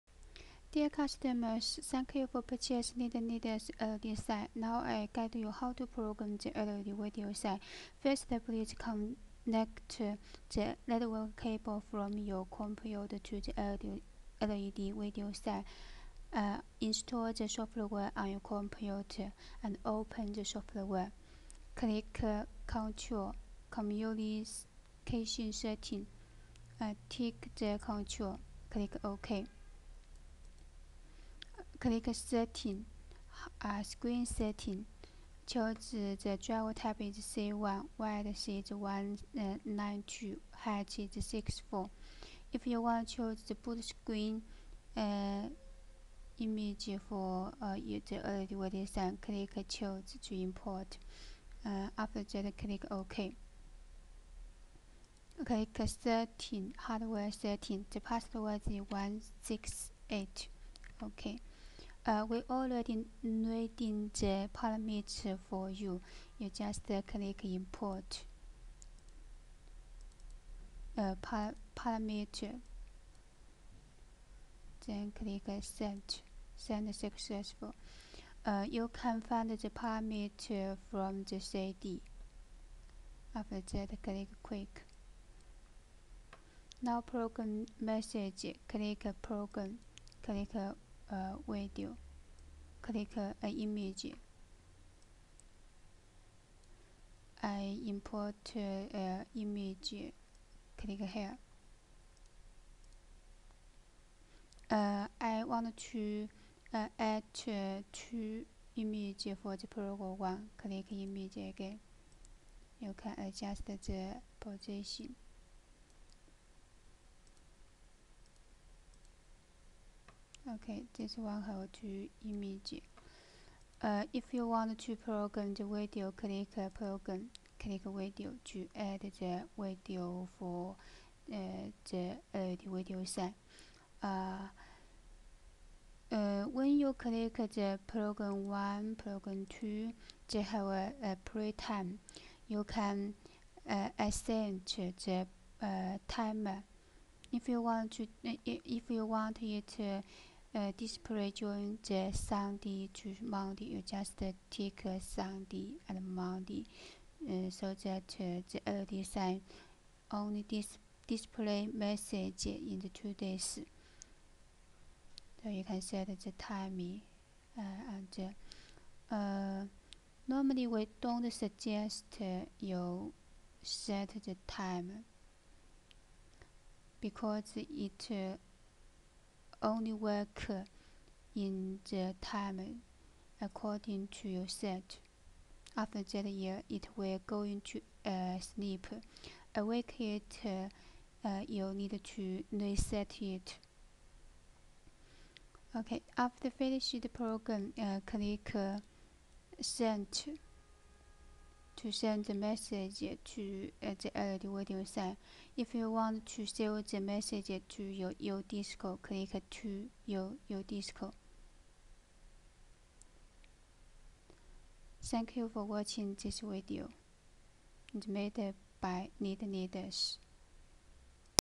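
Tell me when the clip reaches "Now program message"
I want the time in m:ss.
1:26.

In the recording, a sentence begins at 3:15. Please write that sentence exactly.
Okay, after finish the program, uh, click uh, send to send the message to uh, the LED radio sign.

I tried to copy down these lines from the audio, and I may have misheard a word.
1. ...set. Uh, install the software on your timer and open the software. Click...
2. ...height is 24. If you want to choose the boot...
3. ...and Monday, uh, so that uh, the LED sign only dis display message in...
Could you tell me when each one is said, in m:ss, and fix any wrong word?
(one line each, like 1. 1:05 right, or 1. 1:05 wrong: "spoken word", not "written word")
1. 0:15 wrong: "computer", not "timer"
2. 0:40 wrong: "64", not "24"
3. 2:35 right.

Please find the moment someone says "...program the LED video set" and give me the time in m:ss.
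0:05.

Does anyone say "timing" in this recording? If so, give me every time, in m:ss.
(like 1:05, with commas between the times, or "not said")
2:46.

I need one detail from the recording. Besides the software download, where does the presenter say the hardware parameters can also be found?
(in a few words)
The CD.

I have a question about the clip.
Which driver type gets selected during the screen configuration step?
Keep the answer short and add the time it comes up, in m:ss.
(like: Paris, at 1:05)
C1, at 0:37.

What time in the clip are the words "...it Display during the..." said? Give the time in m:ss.
2:29.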